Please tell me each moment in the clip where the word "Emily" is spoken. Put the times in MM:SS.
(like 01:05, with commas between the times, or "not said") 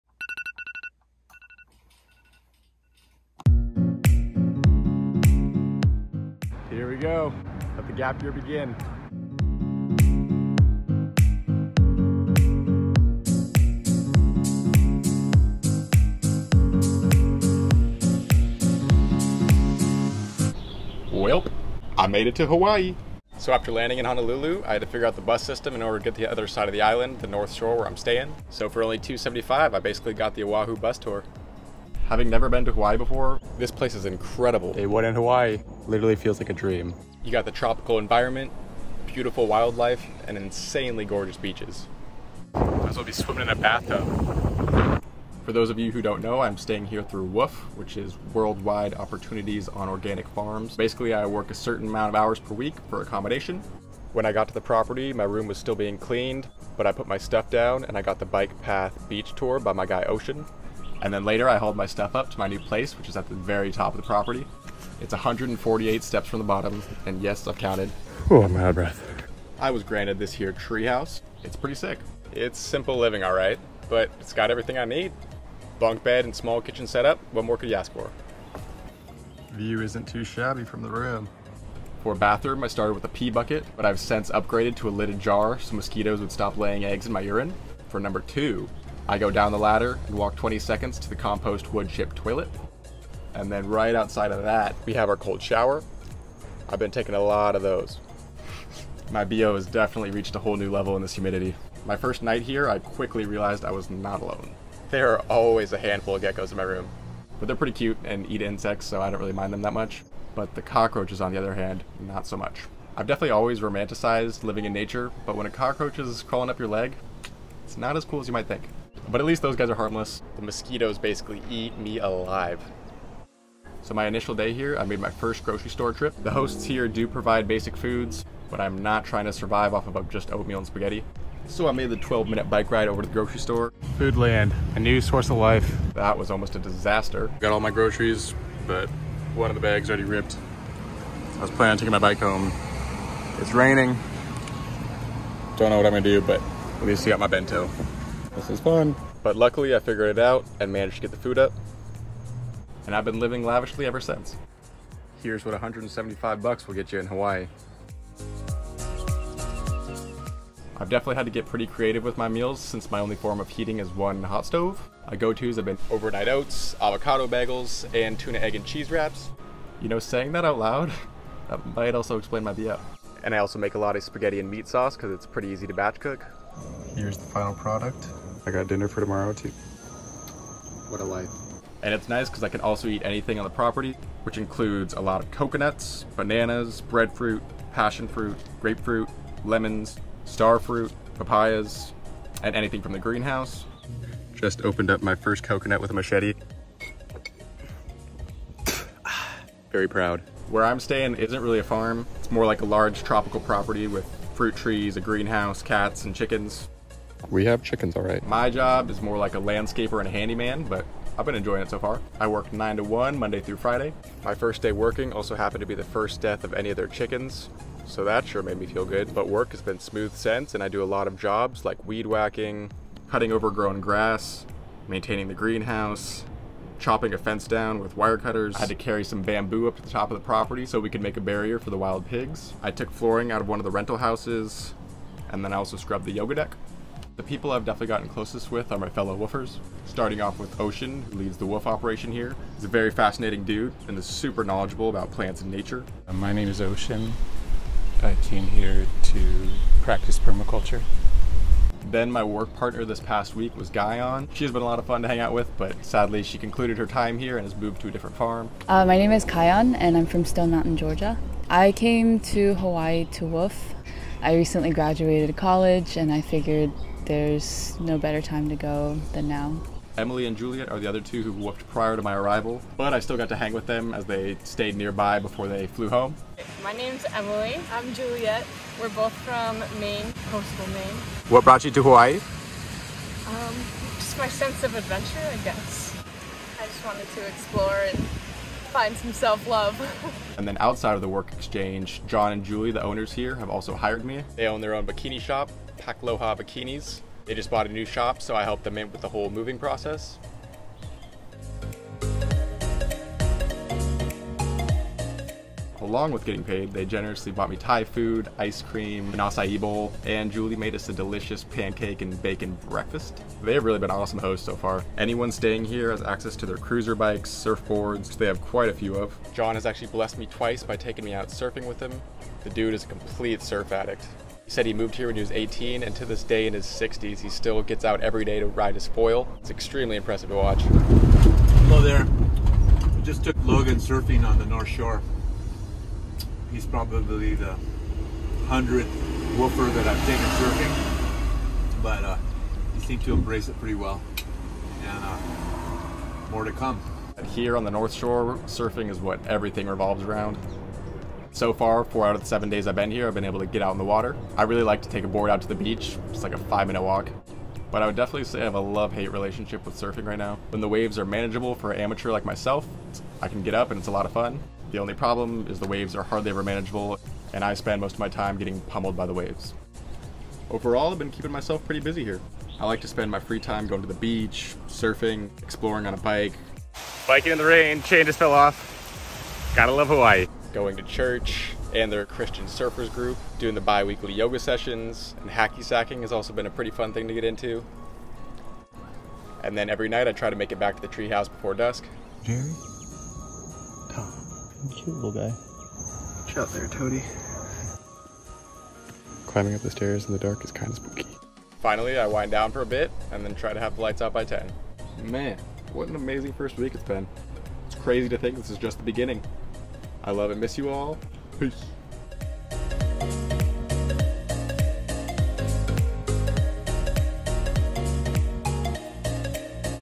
04:29, 04:37.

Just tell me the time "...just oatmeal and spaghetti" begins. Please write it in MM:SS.
02:10.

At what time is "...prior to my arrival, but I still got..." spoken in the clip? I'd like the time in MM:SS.
04:31.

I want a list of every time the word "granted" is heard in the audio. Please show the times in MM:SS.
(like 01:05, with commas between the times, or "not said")
01:09.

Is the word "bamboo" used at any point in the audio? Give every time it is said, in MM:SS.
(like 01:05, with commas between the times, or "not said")
03:49.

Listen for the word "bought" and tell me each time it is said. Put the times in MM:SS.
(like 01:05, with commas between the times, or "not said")
04:57, 05:07.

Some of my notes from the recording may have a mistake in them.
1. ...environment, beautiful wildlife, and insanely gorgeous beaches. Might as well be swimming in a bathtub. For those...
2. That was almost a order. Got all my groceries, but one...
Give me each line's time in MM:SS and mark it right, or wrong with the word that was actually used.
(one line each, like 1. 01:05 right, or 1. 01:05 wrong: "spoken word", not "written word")
1. 00:37 right
2. 02:15 wrong: "disaster", not "order".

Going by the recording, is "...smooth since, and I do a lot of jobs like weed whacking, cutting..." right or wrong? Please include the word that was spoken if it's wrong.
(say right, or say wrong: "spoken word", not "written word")
right.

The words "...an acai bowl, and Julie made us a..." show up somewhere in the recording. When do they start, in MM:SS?
05:09.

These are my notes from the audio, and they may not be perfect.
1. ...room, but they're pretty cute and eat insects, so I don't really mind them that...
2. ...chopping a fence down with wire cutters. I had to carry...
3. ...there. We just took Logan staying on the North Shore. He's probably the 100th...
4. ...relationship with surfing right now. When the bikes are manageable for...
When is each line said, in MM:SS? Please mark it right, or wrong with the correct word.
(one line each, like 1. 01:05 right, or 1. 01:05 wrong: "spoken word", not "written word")
1. 01:46 right
2. 03:46 right
3. 05:31 wrong: "surfing", not "staying"
4. 05:59 wrong: "waves", not "bikes".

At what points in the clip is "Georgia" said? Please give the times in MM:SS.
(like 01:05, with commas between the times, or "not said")
04:20.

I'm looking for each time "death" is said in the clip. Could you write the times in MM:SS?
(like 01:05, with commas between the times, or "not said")
03:36.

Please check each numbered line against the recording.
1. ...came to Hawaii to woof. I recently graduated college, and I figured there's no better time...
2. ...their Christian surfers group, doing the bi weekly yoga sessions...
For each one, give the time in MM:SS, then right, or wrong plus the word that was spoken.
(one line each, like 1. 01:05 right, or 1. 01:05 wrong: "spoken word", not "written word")
1. 04:21 right
2. 06:21 right.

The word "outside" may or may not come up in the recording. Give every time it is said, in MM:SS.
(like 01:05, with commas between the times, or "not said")
01:33, 04:50.